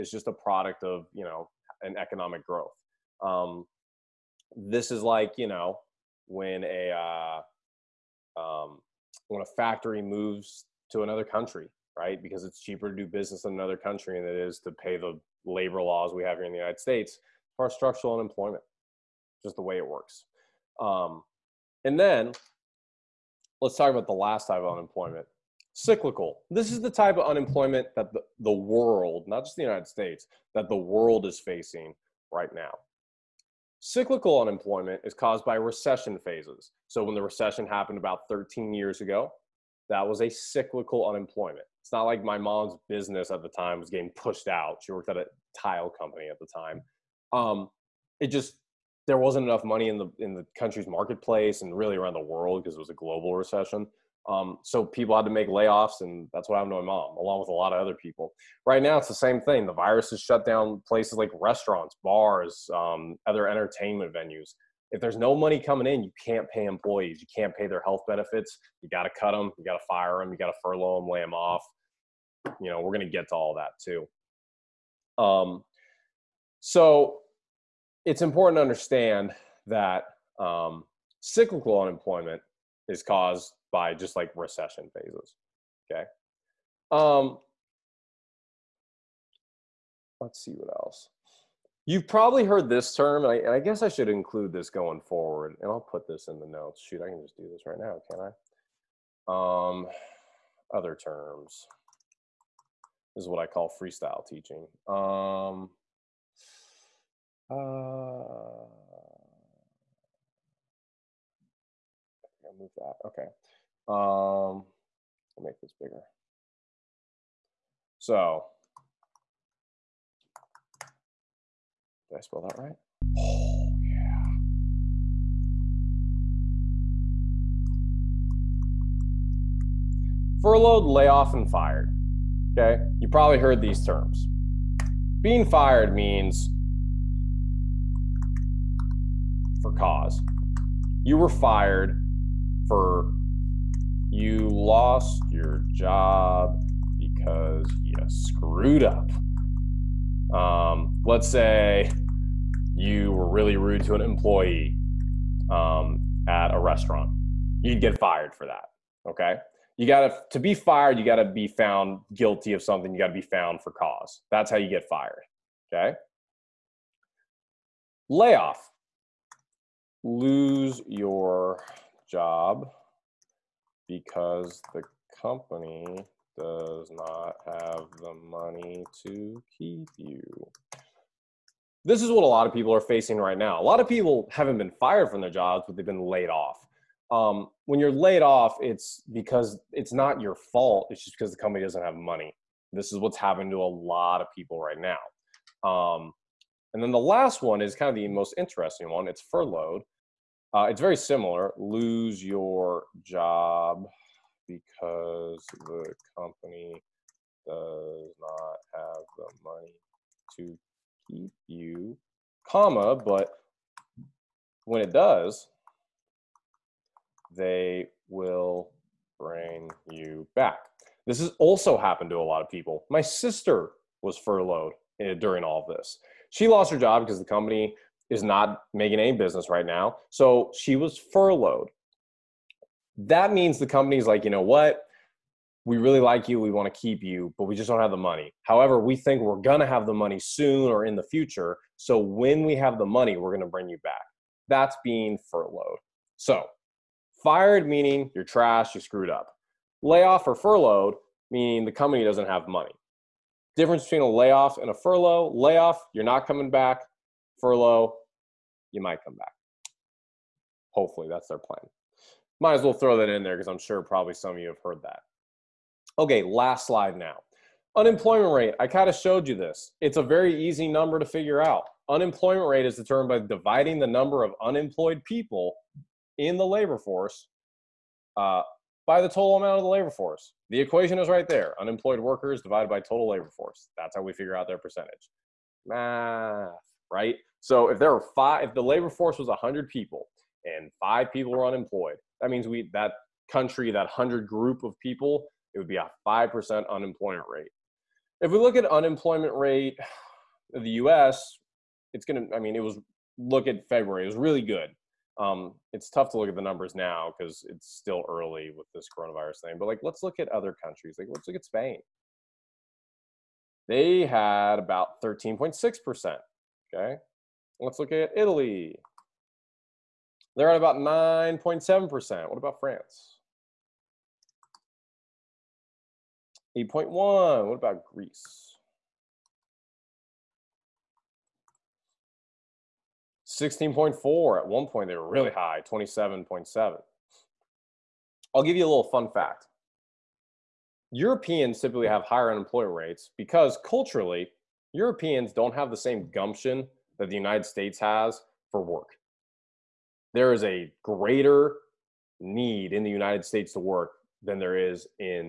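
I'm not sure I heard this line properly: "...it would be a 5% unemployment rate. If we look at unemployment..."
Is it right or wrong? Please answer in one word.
right.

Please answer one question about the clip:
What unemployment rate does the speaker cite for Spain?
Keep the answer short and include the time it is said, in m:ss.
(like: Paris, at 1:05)
13.6%, at 5:15.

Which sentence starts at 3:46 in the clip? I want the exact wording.
She lost her job because the company is not making any business right now.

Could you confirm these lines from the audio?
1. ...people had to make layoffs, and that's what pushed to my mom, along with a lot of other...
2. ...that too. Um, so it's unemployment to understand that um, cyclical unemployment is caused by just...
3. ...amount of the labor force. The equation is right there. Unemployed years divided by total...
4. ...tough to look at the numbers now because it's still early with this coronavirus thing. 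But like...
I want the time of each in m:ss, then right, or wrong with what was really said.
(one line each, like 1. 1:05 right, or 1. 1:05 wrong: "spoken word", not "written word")
1. 0:54 wrong: "happened", not "pushed"
2. 1:13 wrong: "important", not "unemployment"
3. 4:39 wrong: "workers", not "years"
4. 5:05 right.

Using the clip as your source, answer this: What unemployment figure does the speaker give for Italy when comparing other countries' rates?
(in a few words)
9.7%.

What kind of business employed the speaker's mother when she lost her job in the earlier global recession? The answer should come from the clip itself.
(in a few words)
Tile company.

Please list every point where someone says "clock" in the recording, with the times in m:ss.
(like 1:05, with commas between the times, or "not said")
not said.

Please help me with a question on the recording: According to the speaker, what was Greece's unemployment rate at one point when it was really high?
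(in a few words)
27.7%.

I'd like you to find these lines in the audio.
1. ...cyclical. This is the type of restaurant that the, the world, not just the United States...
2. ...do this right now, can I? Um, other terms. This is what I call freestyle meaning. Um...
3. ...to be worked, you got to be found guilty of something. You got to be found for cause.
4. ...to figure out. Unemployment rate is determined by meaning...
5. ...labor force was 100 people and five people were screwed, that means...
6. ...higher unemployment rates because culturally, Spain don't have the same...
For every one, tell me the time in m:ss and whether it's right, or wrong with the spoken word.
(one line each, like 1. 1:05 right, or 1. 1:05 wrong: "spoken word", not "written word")
1. 0:25 wrong: "unemployment", not "restaurant"
2. 1:37 wrong: "teaching", not "meaning"
3. 2:40 wrong: "fired", not "worked"
4. 4:30 wrong: "dividing", not "meaning"
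5. 4:48 wrong: "unemployed", not "screwed"
6. 5:42 wrong: "Europeans", not "Spain".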